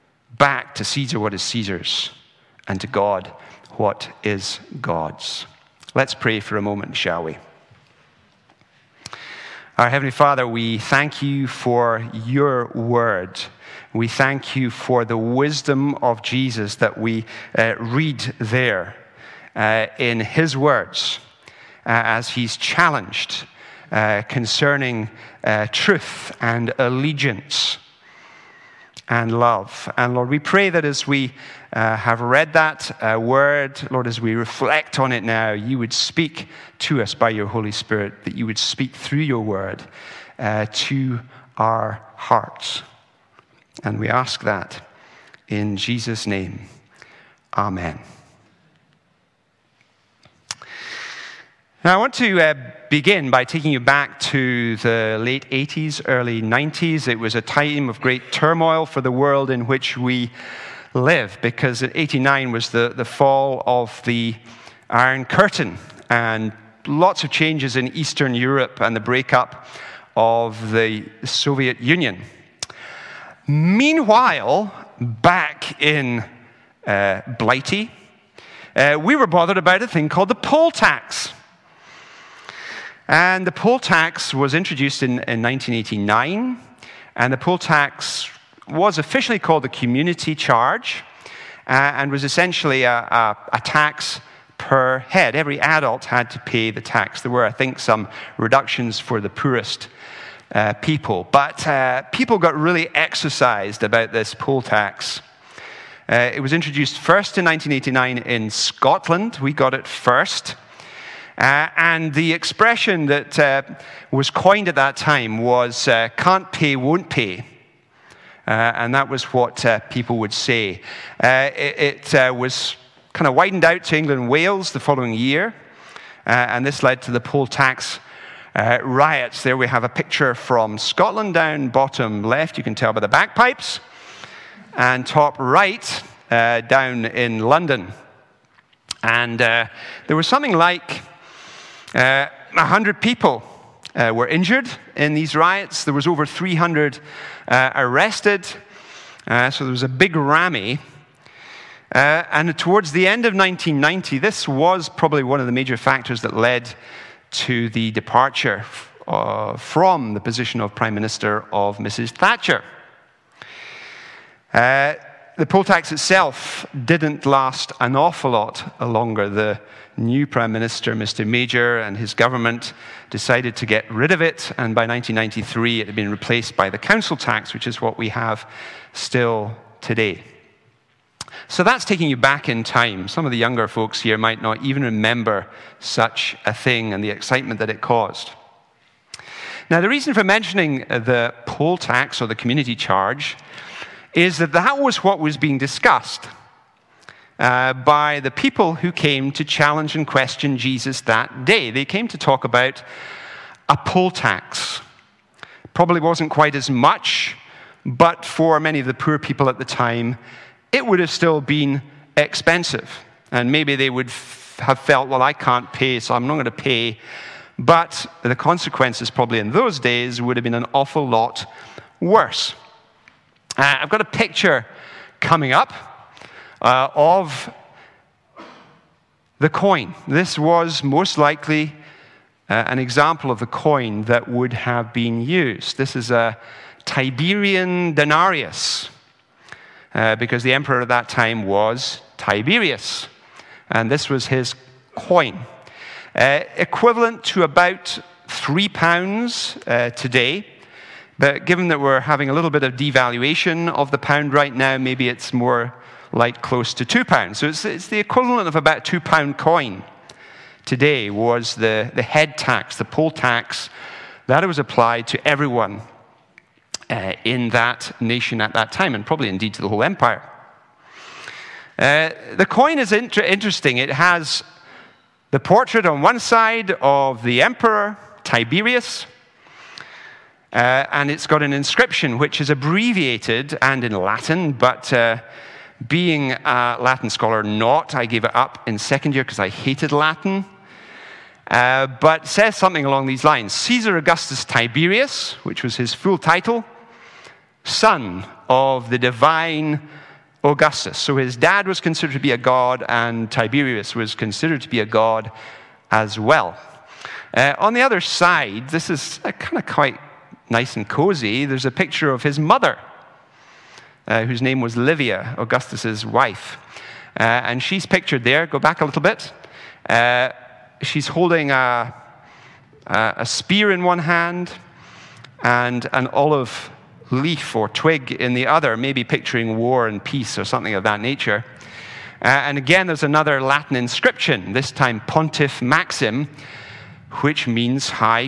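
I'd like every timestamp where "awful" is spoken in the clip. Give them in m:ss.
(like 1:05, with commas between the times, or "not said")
2:47, 3:40.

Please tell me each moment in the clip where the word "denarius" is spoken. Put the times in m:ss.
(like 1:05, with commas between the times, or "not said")
3:57.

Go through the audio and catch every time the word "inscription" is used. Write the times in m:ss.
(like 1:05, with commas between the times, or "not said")
4:41, 5:33.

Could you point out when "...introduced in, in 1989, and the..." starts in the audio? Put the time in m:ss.
1:24.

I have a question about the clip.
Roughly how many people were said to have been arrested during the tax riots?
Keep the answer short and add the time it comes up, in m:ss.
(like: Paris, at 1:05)
over 300, at 2:26.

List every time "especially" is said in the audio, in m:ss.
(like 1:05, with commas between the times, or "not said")
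not said.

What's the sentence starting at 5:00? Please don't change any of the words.
So his dad was considered to be a god, and Tiberius was considered to be a god as well.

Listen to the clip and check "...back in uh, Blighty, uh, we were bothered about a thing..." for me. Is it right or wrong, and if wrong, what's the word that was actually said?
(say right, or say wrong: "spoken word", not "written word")
right.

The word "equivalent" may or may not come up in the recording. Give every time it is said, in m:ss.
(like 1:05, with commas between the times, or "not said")
4:06, 4:17.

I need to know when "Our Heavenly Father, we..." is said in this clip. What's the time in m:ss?
0:09.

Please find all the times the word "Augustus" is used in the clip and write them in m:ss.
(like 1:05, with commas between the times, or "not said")
4:53, 5:00, 5:15.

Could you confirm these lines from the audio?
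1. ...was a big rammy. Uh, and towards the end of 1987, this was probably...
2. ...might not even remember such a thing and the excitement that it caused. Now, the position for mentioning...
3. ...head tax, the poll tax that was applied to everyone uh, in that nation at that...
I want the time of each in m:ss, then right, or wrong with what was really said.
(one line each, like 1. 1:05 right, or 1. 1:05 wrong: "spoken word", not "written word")
1. 2:29 wrong: "1990", not "1987"
2. 3:04 wrong: "reason", not "position"
3. 4:22 right.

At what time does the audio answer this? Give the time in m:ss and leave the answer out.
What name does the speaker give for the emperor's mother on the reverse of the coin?
5:14.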